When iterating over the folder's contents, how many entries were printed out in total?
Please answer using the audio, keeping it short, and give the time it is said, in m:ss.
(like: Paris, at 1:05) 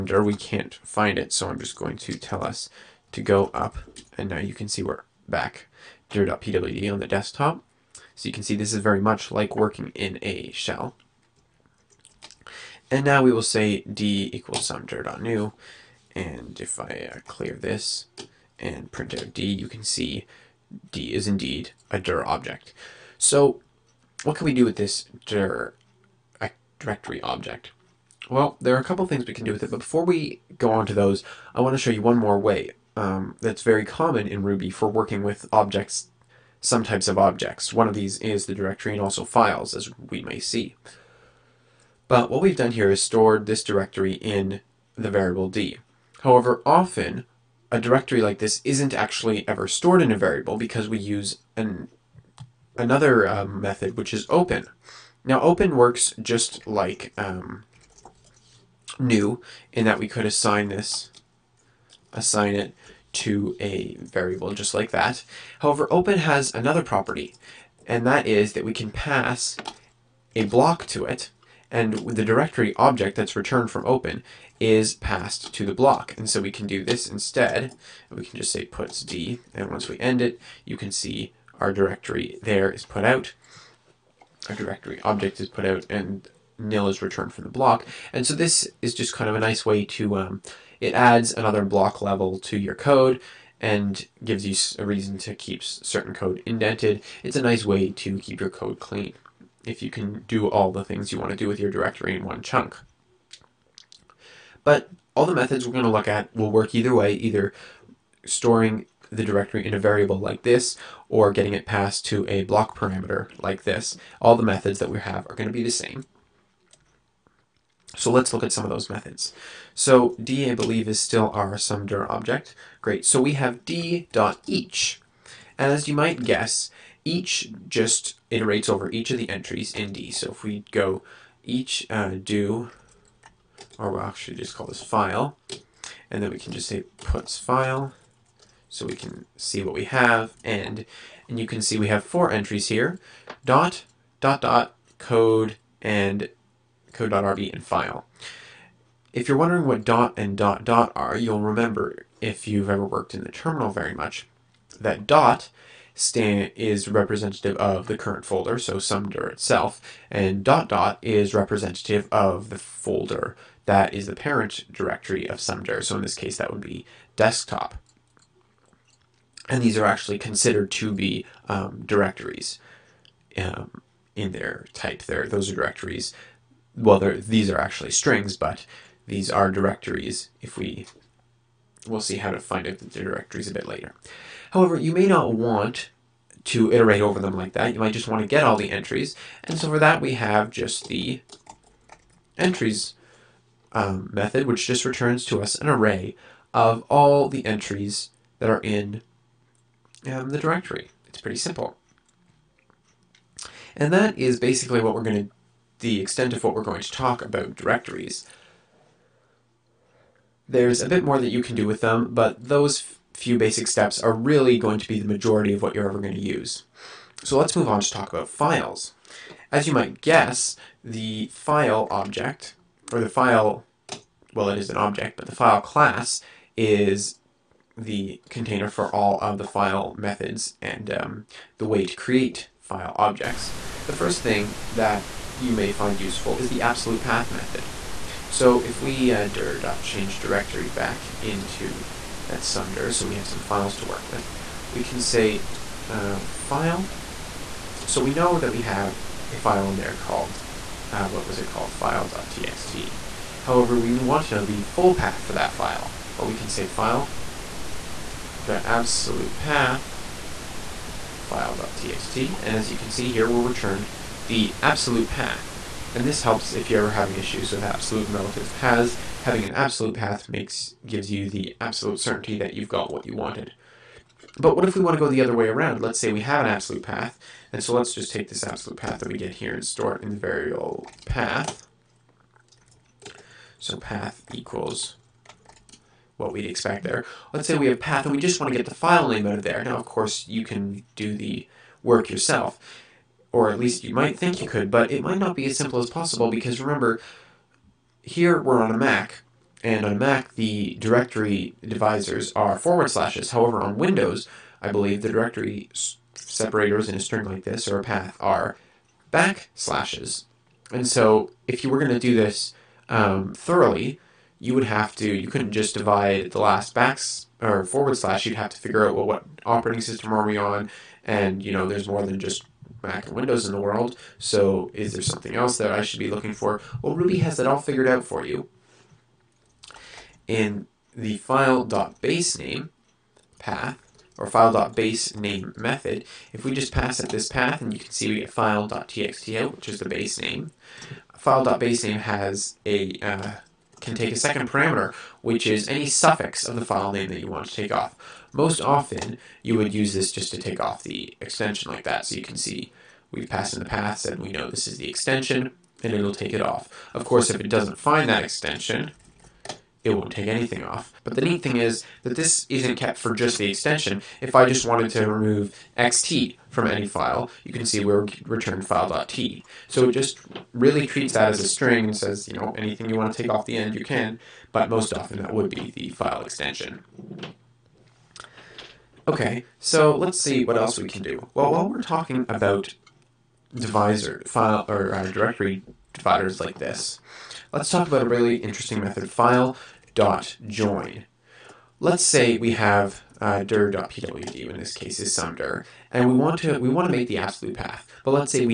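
4, at 2:22.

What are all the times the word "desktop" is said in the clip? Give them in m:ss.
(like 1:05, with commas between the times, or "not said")
0:07, 2:47.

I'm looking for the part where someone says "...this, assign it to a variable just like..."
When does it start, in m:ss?
1:00.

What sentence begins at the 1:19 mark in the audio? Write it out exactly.
And once we end it, you can see our directory there is put out.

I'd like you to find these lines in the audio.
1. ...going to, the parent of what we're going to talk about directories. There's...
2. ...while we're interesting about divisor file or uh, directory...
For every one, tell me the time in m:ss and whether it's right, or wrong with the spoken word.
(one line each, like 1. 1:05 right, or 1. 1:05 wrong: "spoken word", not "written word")
1. 3:25 wrong: "extent", not "parent"
2. 6:21 wrong: "talking", not "interesting".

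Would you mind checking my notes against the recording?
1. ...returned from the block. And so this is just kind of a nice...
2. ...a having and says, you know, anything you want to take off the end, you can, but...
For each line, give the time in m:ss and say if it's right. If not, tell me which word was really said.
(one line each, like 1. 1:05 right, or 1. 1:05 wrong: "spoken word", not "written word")
1. 1:27 right
2. 6:11 wrong: "string", not "having".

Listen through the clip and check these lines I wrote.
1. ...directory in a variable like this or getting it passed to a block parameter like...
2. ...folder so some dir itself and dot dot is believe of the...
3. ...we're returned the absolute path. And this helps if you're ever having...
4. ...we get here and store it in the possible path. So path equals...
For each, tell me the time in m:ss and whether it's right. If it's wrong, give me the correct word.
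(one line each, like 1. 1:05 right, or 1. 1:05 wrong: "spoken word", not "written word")
1. 1:49 right
2. 2:38 wrong: "representative", not "believe"
3. 4:23 right
4. 4:39 wrong: "variable", not "possible".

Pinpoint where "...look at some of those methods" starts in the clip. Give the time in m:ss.
1:58.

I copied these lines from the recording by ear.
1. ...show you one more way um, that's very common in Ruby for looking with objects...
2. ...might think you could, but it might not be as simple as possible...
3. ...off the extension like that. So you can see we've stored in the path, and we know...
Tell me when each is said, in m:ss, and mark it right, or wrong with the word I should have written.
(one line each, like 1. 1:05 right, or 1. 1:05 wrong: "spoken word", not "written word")
1. 0:31 wrong: "working", not "looking"
2. 4:53 right
3. 5:50 wrong: "passed", not "stored".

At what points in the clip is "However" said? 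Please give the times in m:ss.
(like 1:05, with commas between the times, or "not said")
0:46, 1:05, 3:04, 4:13, 5:03.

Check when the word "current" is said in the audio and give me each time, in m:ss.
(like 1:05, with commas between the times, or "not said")
2:37.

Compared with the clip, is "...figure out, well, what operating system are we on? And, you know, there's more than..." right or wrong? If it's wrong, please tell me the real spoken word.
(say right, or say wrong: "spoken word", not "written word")
right.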